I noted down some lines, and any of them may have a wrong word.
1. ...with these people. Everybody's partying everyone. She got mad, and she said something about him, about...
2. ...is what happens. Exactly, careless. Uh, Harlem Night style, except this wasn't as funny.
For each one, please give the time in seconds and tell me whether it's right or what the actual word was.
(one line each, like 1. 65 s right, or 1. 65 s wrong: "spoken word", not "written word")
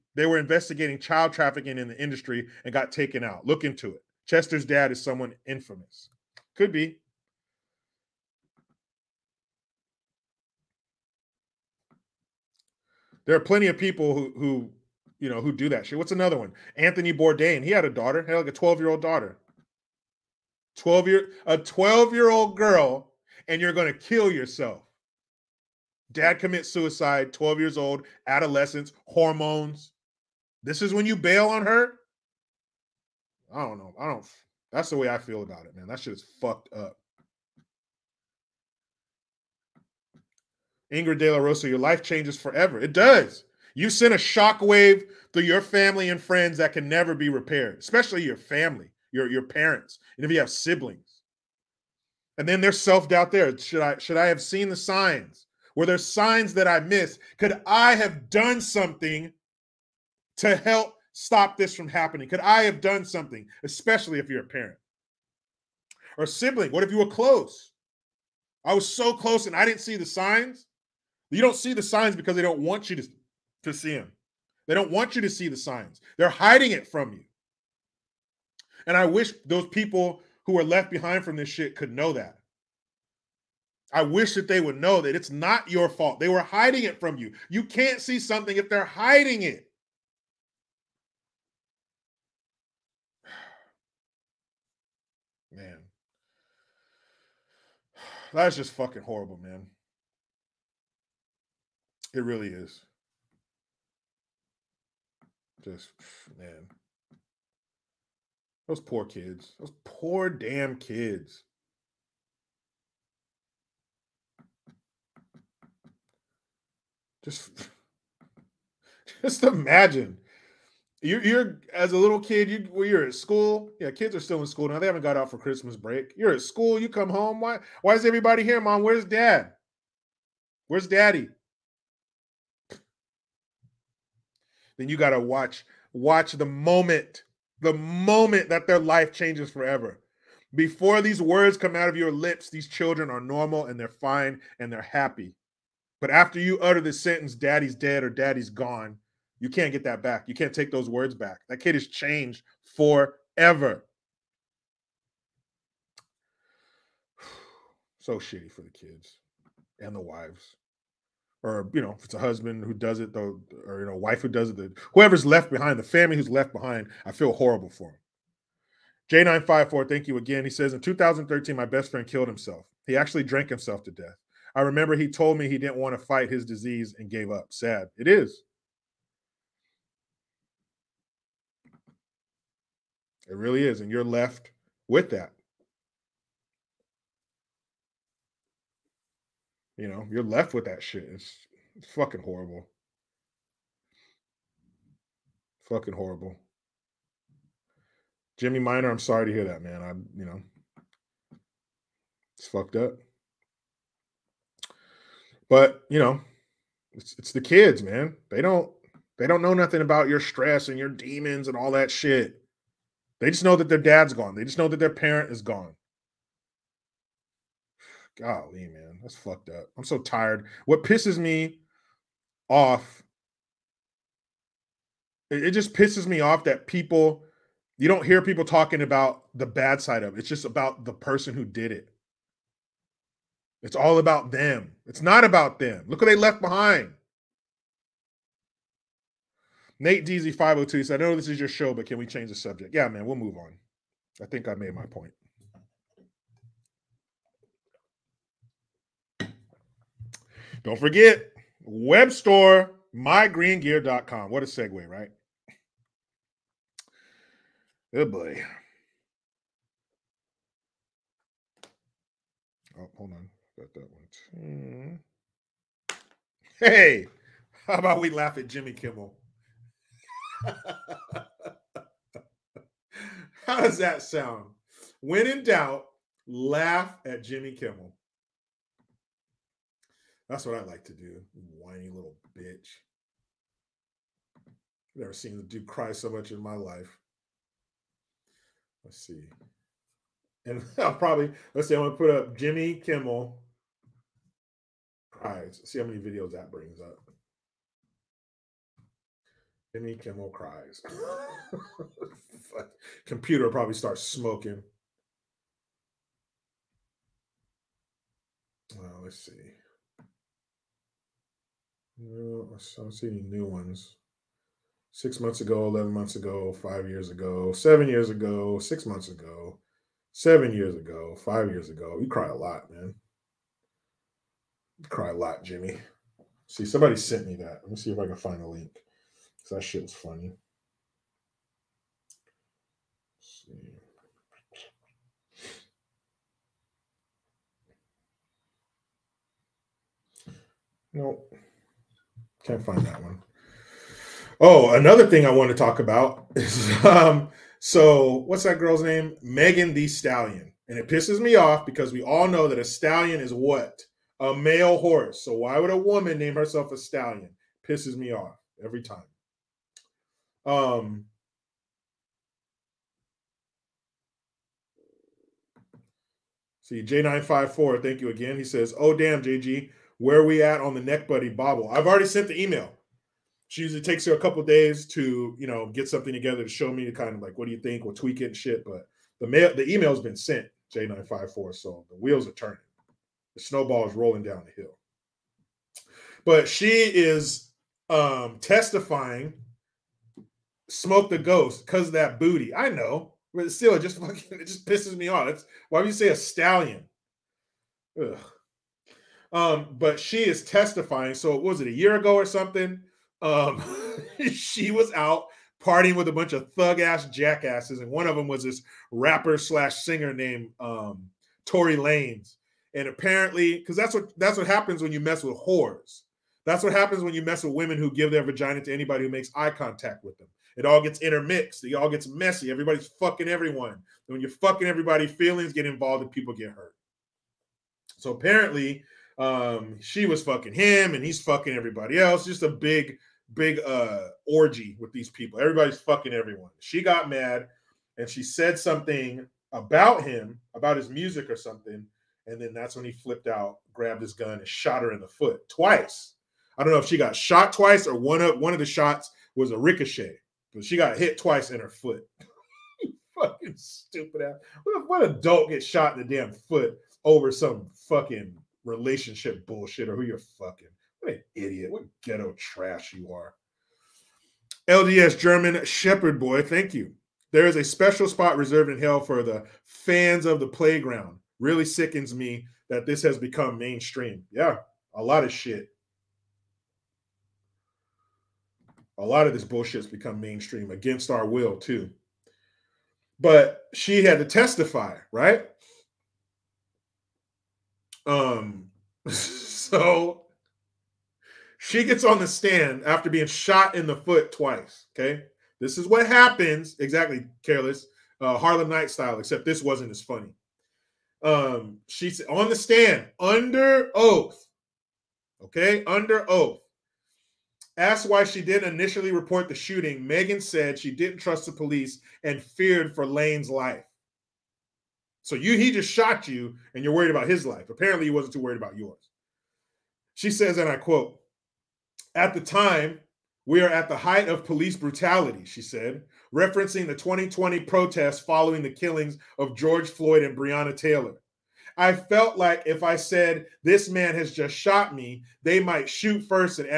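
1. 434 s wrong: "fucking", not "partying"
2. 495 s right.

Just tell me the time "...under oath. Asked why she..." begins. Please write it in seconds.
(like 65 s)
505 s.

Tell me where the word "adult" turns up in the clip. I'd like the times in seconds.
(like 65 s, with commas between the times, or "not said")
455 s.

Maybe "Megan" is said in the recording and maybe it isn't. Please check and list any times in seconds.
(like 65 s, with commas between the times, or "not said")
349 s, 510 s.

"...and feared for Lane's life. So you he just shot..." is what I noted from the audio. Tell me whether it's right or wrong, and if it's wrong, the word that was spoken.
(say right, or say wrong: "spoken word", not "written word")
right.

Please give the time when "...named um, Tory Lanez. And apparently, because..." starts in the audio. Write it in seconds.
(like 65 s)
410 s.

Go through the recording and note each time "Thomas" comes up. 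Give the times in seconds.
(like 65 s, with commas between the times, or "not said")
not said.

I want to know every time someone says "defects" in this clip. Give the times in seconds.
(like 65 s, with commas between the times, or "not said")
not said.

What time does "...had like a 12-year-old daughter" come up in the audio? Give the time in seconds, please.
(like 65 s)
18 s.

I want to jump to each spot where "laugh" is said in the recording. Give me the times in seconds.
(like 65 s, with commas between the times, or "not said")
268 s, 276 s.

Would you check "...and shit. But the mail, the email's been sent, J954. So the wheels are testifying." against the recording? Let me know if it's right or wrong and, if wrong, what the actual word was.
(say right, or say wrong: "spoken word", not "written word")
wrong: "turning", not "testifying".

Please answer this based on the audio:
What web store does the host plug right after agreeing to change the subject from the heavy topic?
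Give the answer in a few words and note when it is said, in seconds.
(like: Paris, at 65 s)
mygreengear.com, at 252 s.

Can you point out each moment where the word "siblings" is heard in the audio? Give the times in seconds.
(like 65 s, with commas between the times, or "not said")
50 s, 66 s.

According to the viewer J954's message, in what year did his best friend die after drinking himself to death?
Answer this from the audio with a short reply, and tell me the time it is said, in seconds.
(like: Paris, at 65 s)
2013, at 170 s.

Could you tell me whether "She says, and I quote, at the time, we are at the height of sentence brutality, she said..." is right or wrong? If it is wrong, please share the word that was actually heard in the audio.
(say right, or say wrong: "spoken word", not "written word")
wrong: "police", not "sentence".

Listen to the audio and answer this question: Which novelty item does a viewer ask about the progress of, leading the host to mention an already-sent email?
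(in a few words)
neck buddy bobble.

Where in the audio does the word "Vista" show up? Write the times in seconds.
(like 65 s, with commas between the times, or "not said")
not said.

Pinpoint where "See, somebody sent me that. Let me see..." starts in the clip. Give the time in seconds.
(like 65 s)
326 s.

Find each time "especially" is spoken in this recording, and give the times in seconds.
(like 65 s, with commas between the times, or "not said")
47 s, 63 s.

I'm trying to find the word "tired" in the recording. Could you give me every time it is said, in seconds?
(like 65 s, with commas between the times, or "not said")
219 s.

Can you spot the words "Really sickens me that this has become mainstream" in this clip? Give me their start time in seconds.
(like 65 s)
471 s.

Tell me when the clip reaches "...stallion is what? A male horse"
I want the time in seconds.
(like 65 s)
352 s.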